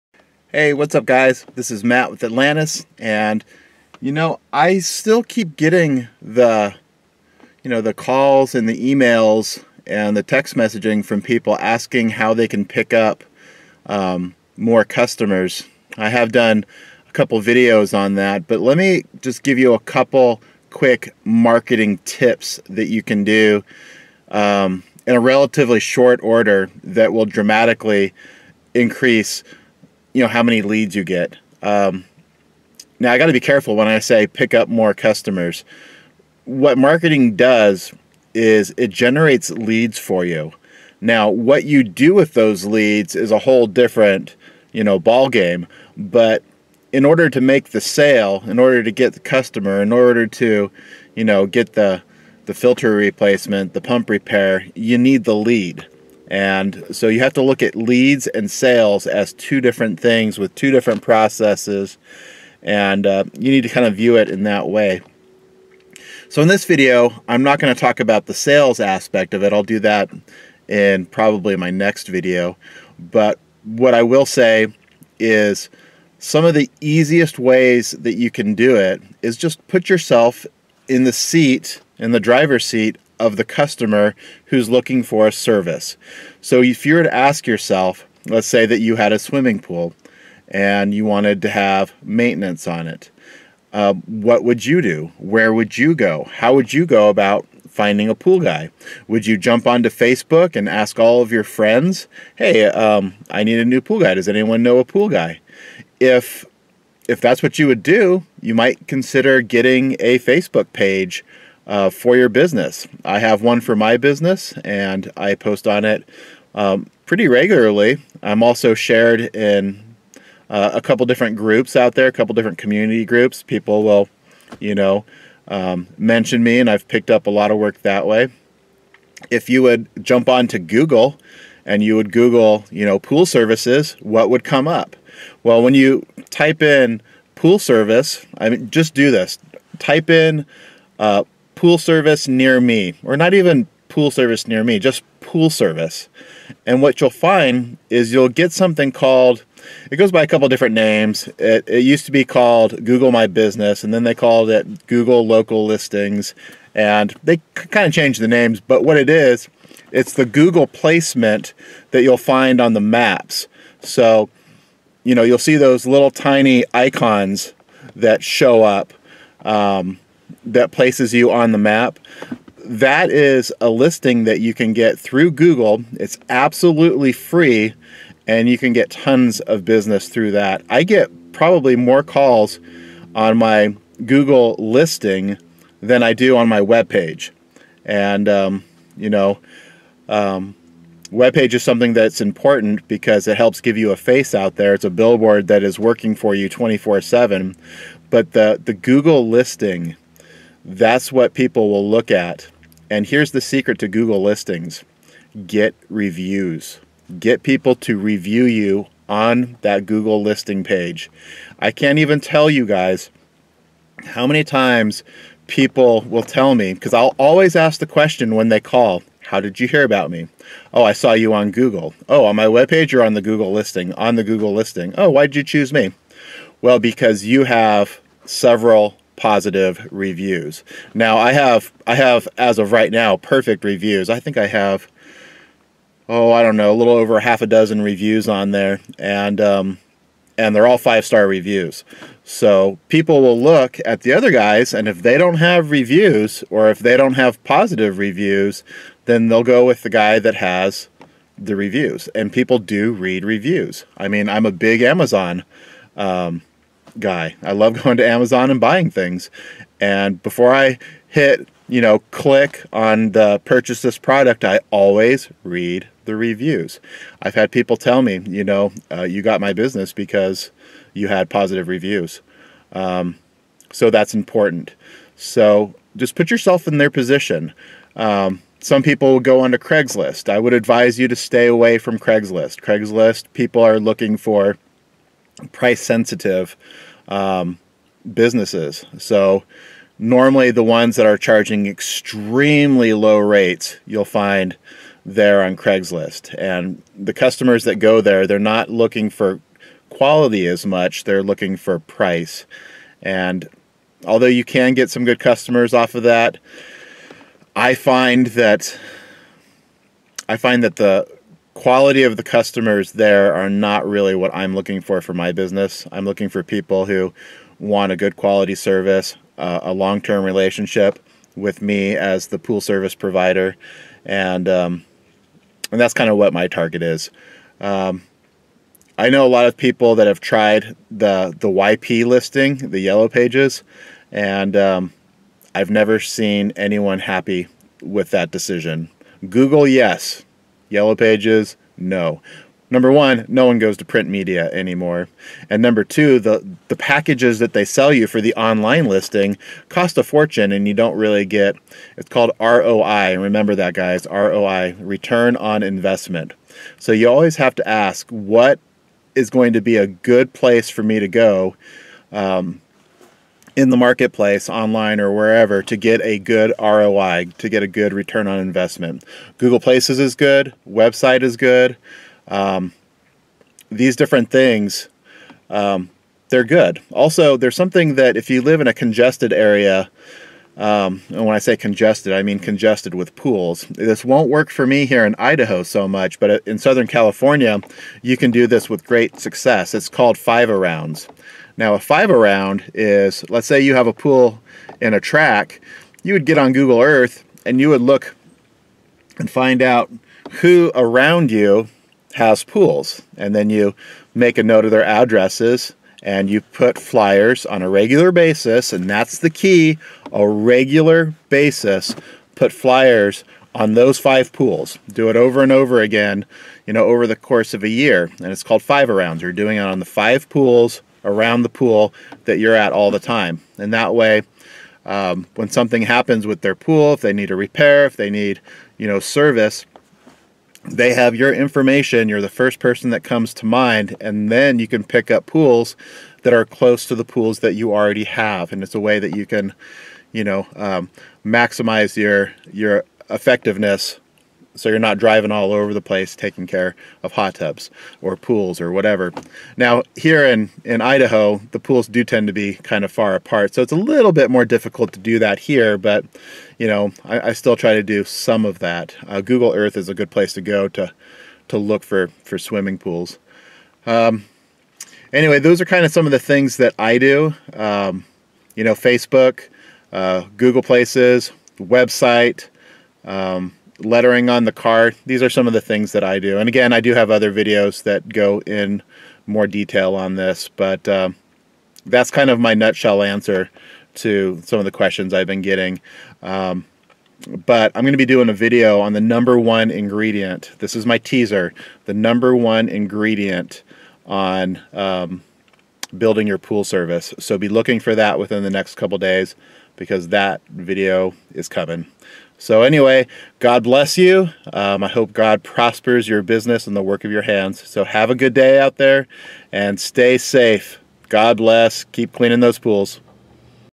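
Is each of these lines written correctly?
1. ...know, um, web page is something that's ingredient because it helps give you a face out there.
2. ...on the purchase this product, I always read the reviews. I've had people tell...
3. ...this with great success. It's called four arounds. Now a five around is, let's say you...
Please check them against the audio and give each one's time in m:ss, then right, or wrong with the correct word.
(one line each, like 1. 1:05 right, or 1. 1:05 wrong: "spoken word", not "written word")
1. 3:09 wrong: "important", not "ingredient"
2. 4:22 right
3. 6:28 wrong: "five", not "four".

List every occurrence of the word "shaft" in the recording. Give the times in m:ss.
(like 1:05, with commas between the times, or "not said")
not said.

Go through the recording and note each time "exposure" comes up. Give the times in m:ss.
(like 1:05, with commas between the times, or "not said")
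not said.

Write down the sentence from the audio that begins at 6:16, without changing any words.
Also, there's something that if you live in a congested area, um, and when I say congested, I mean congested with pools.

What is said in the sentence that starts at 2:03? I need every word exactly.
People will, you know, um, mention me and I've picked up a lot of work that way.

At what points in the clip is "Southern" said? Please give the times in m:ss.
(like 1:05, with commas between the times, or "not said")
6:26.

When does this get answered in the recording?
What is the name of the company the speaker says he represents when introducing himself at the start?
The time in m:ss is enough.
0:02.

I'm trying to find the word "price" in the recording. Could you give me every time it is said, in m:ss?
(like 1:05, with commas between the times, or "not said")
4:45, 5:01.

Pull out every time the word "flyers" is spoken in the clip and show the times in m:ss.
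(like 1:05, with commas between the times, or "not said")
6:46, 6:52.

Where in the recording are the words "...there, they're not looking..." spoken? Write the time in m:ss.
4:58.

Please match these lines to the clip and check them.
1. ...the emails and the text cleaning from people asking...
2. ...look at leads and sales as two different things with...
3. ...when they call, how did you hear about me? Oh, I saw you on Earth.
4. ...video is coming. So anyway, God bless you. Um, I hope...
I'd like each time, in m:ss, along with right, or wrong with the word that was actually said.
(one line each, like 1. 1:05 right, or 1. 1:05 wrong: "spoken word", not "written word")
1. 0:08 wrong: "messaging", not "cleaning"
2. 0:57 right
3. 3:38 wrong: "Google", not "Earth"
4. 8:20 right.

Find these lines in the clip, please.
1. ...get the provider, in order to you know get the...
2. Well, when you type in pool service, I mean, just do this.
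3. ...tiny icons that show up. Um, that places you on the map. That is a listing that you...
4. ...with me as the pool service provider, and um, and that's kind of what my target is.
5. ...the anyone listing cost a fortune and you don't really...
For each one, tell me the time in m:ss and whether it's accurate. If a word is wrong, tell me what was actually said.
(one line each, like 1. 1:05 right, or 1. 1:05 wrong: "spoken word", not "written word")
1. 0:48 wrong: "customer", not "provider"
2. 2:15 right
3. 2:46 right
4. 5:21 right
5. 5:48 wrong: "online", not "anyone".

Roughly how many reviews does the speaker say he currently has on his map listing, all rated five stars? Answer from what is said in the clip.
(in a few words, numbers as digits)
a little over half a dozen.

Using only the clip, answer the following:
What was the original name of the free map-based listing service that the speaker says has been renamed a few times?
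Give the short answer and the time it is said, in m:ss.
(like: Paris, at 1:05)
Google My Business, at 2:32.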